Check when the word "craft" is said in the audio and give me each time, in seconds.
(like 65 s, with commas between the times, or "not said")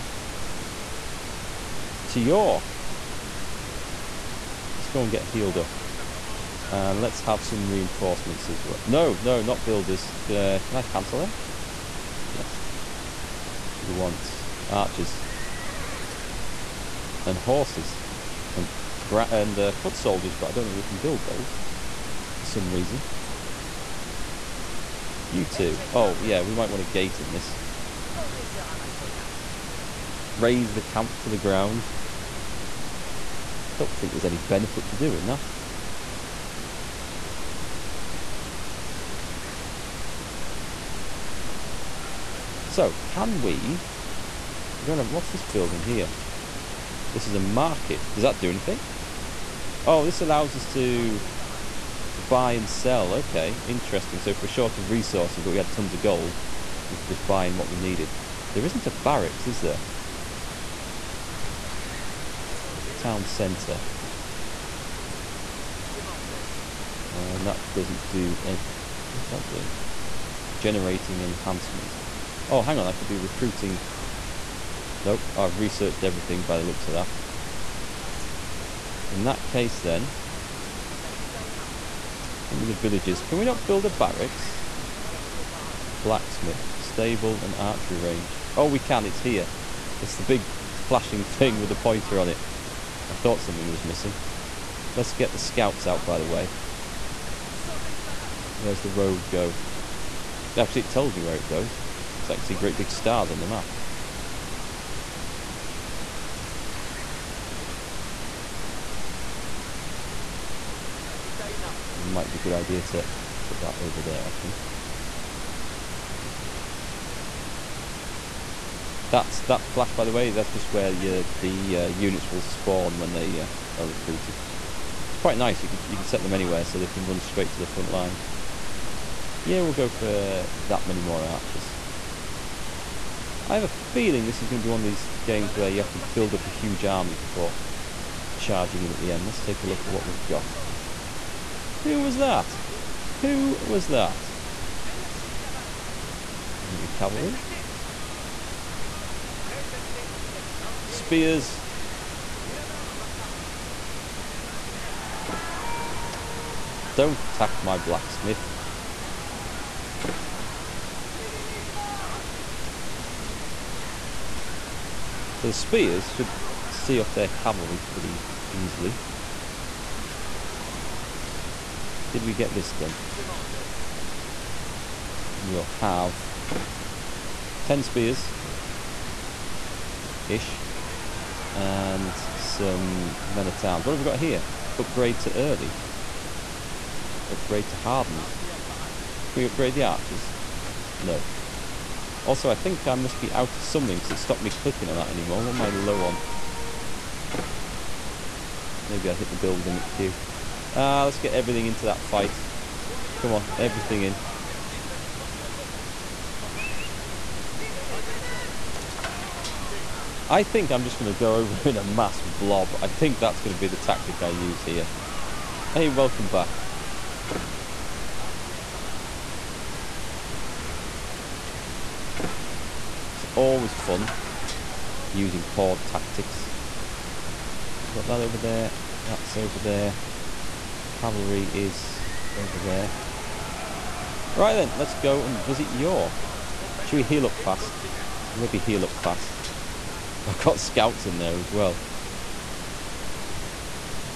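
not said.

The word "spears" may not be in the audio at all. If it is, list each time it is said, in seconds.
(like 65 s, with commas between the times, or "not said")
150 s, 165 s, 177 s.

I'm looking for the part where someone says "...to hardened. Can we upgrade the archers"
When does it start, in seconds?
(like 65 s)
187 s.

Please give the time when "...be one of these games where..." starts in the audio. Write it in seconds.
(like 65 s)
134 s.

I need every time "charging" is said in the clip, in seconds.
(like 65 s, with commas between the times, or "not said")
138 s.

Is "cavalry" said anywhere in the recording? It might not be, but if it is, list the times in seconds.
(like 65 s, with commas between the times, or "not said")
146 s, 167 s, 231 s.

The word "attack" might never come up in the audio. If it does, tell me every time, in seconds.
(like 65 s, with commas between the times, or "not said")
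157 s.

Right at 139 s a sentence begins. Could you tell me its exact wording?
Let's take a look at what we've got.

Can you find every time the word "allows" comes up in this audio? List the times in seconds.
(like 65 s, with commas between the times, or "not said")
50 s.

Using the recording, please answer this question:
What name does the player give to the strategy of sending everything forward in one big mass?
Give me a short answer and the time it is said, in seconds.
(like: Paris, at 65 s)
horde tactics, at 225 s.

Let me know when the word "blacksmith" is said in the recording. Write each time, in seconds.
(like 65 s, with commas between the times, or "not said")
86 s, 157 s.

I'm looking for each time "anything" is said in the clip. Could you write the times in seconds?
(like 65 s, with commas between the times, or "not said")
48 s.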